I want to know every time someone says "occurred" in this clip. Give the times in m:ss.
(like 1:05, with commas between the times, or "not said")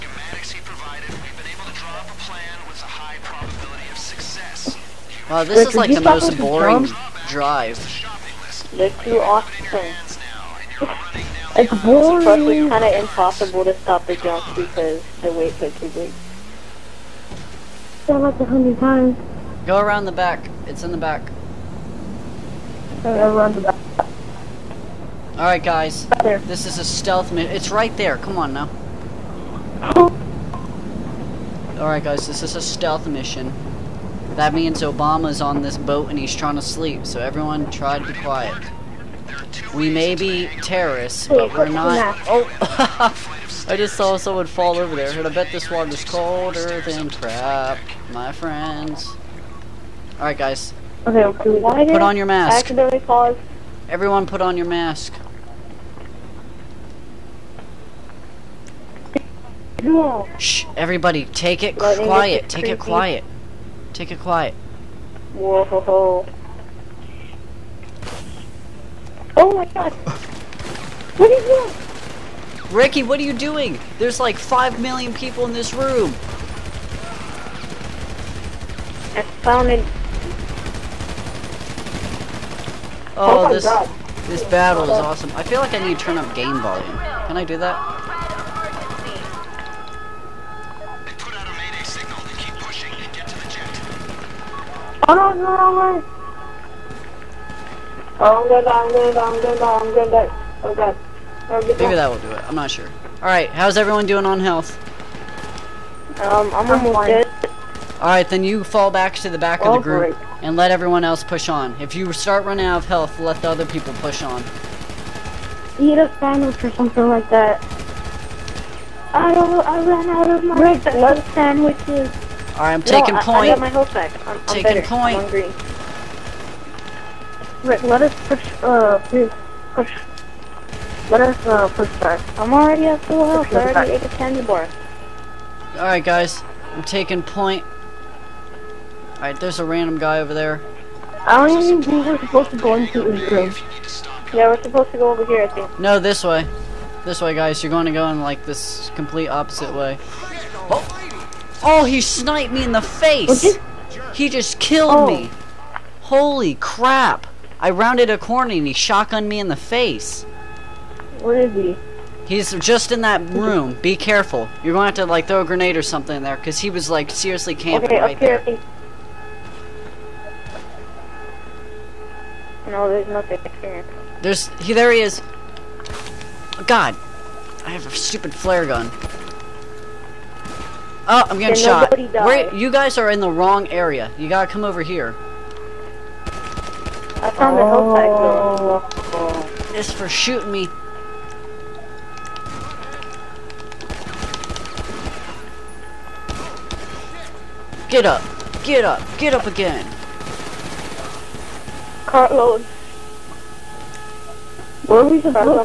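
not said.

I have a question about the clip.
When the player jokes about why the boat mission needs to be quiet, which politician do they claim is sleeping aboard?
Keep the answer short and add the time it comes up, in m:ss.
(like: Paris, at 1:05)
Obama, at 0:34.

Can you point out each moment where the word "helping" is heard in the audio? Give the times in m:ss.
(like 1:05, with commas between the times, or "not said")
not said.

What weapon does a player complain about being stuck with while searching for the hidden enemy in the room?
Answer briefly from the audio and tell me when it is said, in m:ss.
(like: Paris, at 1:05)
Flare gun, at 2:58.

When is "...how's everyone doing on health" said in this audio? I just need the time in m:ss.
1:43.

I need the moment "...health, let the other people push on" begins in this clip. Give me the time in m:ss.
1:52.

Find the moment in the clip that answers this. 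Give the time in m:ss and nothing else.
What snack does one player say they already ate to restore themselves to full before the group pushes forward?
2:14.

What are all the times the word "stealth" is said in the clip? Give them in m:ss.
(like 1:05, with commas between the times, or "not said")
0:26, 0:32.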